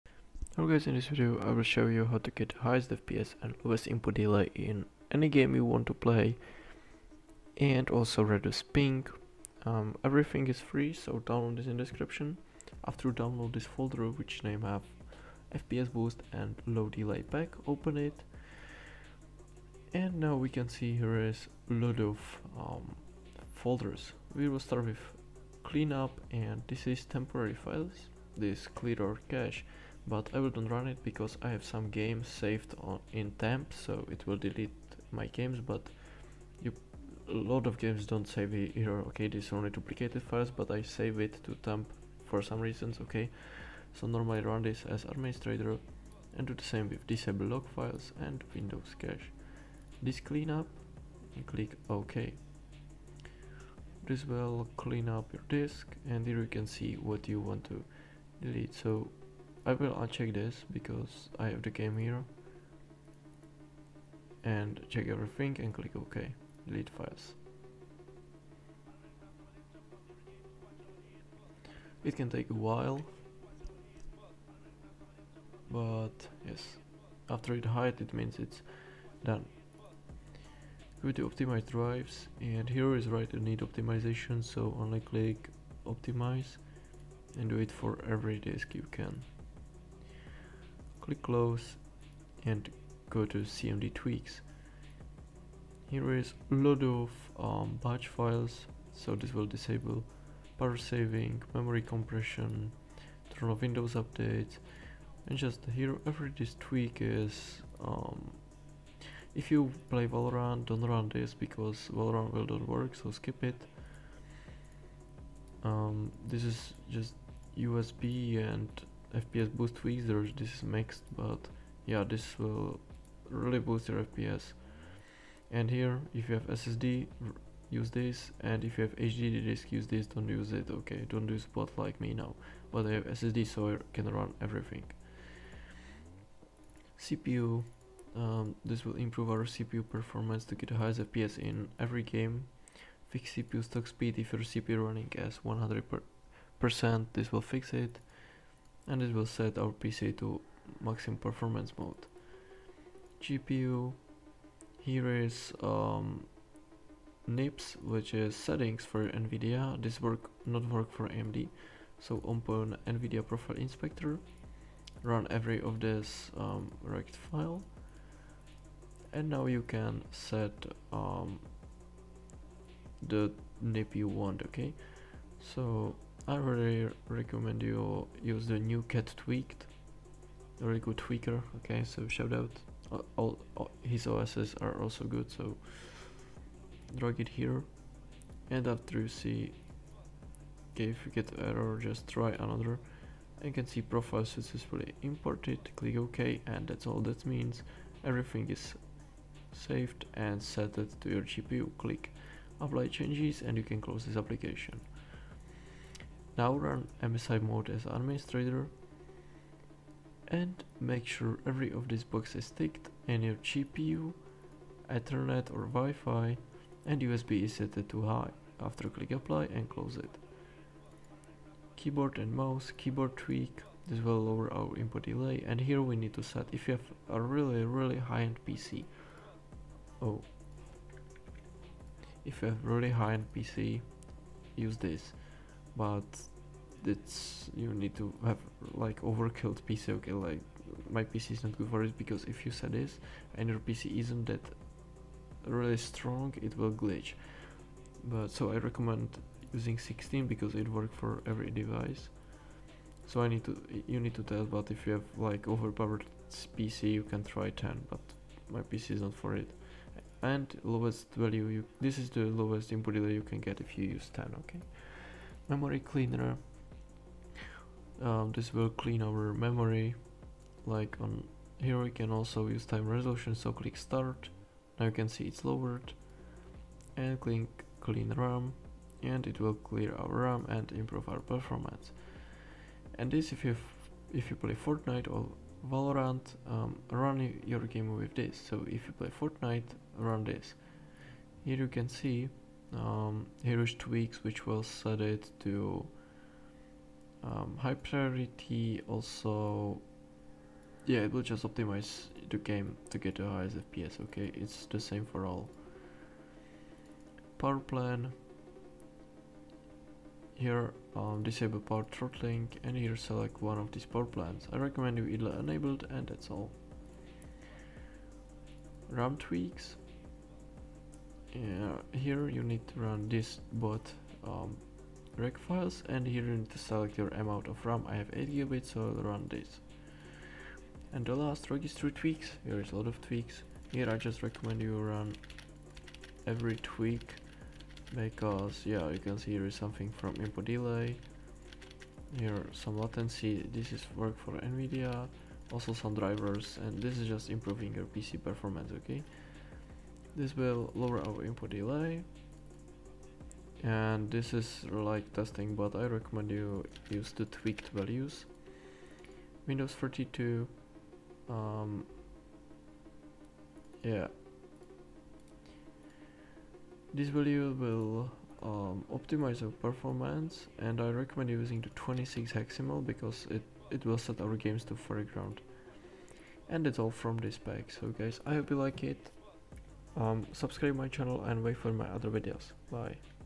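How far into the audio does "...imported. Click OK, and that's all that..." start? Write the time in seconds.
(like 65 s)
195 s.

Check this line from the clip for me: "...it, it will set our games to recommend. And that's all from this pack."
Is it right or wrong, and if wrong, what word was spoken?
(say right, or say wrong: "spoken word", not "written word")
wrong: "foreground", not "recommend".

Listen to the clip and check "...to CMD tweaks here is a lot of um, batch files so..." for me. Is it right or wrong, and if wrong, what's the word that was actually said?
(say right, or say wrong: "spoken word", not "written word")
right.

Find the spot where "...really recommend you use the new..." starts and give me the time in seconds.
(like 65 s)
176 s.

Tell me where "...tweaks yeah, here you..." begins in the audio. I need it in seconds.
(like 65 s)
319 s.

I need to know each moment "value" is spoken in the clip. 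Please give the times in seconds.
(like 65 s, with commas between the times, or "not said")
261 s, 357 s, 367 s.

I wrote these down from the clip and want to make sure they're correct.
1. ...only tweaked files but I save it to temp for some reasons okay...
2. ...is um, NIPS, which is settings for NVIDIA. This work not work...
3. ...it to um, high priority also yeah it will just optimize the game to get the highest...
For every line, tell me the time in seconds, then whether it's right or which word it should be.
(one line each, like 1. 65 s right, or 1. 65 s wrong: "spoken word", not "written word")
1. 39 s wrong: "duplicated", not "tweaked"
2. 155 s right
3. 295 s right.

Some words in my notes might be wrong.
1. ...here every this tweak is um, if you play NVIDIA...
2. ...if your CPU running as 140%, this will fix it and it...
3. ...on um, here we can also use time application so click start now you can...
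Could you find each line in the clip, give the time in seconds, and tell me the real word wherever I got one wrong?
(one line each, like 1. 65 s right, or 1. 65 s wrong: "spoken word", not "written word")
1. 105 s wrong: "Valorant", not "NVIDIA"
2. 144 s wrong: "100", not "140"
3. 271 s wrong: "resolution", not "application".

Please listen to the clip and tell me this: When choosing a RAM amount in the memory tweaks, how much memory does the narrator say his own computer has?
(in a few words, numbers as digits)
8 GB.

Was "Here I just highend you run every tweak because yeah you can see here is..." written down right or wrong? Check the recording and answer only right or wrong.
wrong.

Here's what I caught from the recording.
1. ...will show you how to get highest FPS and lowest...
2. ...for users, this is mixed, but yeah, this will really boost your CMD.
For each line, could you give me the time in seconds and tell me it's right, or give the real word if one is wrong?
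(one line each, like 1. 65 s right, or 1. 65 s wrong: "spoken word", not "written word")
1. 1 s right
2. 119 s wrong: "FPS", not "CMD".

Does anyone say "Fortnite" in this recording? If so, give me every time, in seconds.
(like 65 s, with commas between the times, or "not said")
284 s, 289 s.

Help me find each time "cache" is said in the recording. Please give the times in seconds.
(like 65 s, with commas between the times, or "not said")
29 s, 48 s.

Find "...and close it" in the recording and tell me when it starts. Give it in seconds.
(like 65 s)
219 s.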